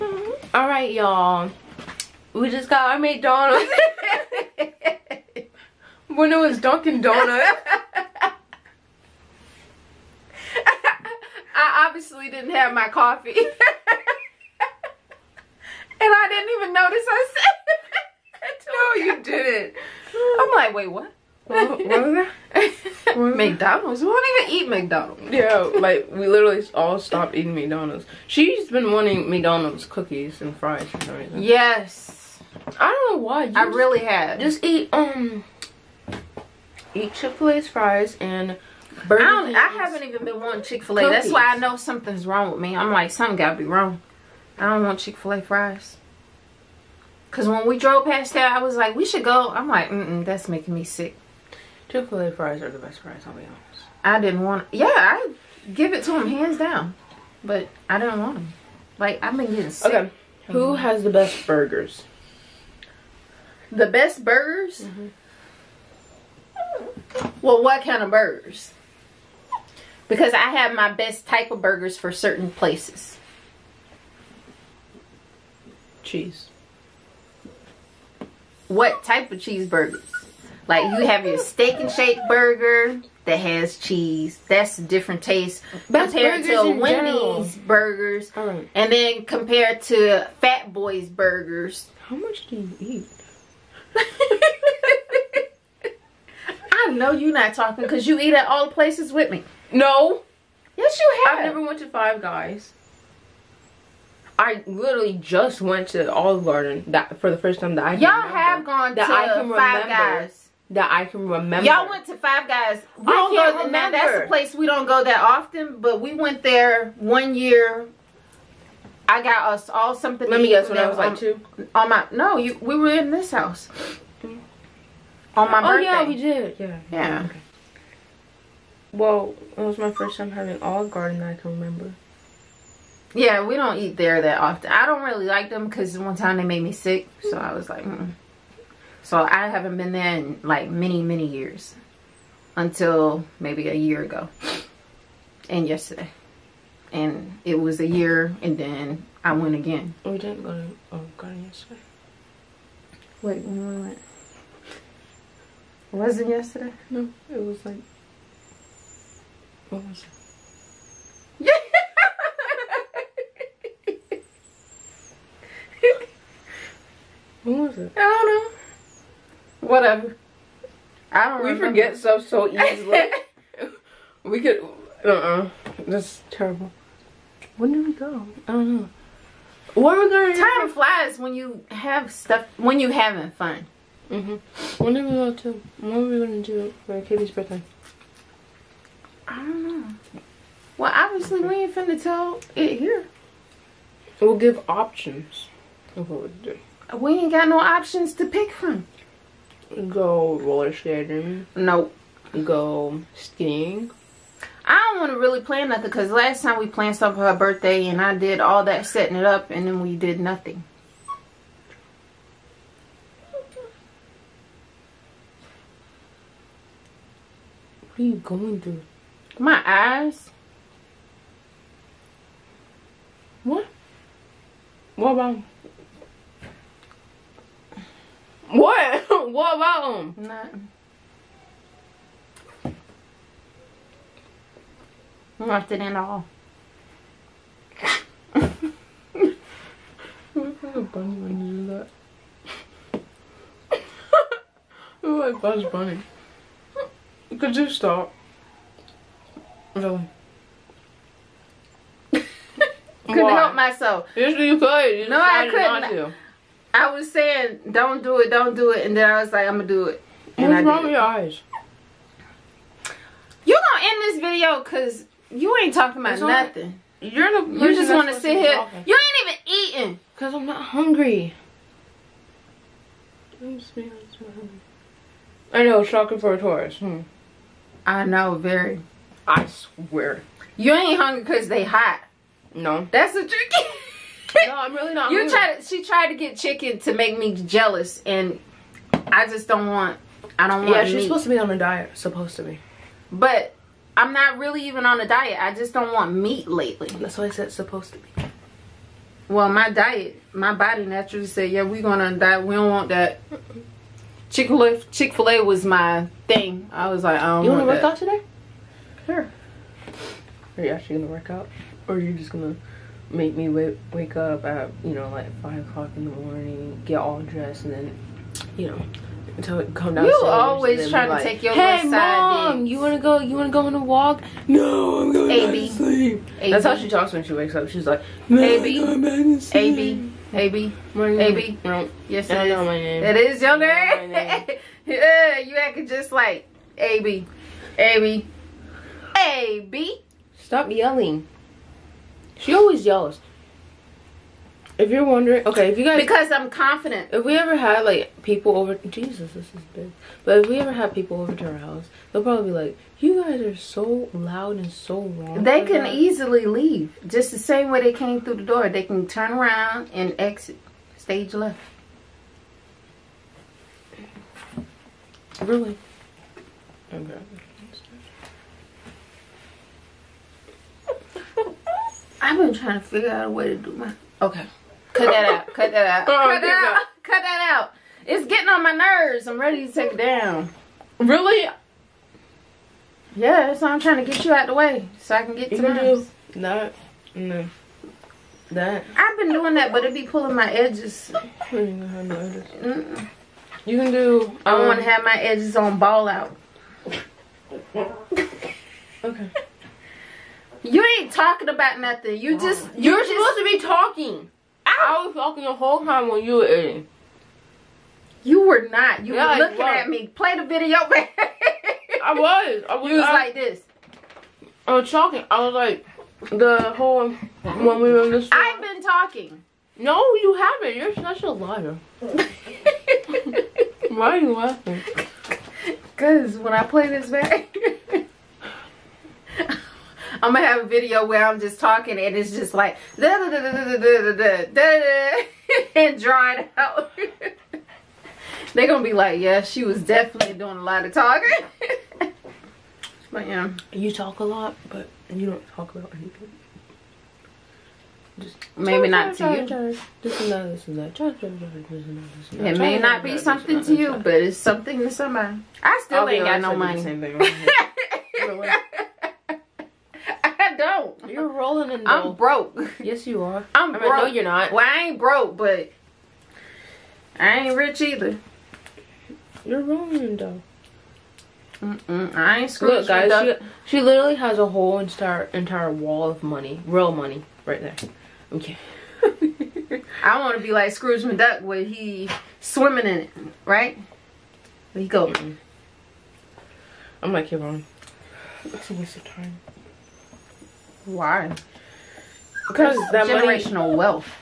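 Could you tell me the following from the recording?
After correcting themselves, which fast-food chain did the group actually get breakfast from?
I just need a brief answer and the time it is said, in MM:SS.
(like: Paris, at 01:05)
Dunkin' Donuts, at 00:06.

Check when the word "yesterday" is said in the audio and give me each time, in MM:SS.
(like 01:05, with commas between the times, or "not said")
02:25, 02:31, 02:36.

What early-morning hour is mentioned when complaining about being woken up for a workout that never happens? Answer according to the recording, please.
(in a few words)
5 o'clock.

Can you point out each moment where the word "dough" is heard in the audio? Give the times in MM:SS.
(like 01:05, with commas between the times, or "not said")
07:50.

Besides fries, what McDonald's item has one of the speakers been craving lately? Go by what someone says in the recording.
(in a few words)
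cookies.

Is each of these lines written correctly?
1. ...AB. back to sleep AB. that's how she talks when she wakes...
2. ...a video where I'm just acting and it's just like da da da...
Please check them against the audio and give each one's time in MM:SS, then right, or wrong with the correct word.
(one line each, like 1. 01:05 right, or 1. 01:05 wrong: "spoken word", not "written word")
1. 05:25 right
2. 07:10 wrong: "talking", not "acting".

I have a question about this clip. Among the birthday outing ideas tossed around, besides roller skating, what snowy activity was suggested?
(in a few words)
skiing.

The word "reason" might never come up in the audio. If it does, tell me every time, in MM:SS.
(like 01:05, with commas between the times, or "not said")
00:31.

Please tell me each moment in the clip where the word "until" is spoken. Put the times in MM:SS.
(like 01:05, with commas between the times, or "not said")
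02:22, 05:19.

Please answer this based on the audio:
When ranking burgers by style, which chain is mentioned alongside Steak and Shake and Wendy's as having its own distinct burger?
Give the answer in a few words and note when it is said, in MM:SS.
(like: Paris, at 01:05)
Fat Boy's, at 01:30.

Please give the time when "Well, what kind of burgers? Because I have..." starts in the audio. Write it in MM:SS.
01:07.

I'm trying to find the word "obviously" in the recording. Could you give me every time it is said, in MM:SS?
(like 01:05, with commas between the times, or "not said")
00:11, 03:10.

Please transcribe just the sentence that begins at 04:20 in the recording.
And What's I wrong with your eyes?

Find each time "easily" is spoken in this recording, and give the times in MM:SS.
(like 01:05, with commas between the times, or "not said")
02:52, 05:55.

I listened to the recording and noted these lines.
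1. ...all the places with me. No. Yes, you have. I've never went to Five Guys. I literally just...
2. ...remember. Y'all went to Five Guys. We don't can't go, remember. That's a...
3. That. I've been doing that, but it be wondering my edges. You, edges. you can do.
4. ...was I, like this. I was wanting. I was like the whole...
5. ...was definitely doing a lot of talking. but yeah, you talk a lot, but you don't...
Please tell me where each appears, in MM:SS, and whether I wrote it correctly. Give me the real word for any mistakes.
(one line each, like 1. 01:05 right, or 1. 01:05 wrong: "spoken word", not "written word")
1. 01:38 right
2. 01:51 right
3. 06:28 wrong: "pulling", not "wondering"
4. 06:52 wrong: "talking", not "wanting"
5. 07:19 right.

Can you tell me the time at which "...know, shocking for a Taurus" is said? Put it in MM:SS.
04:35.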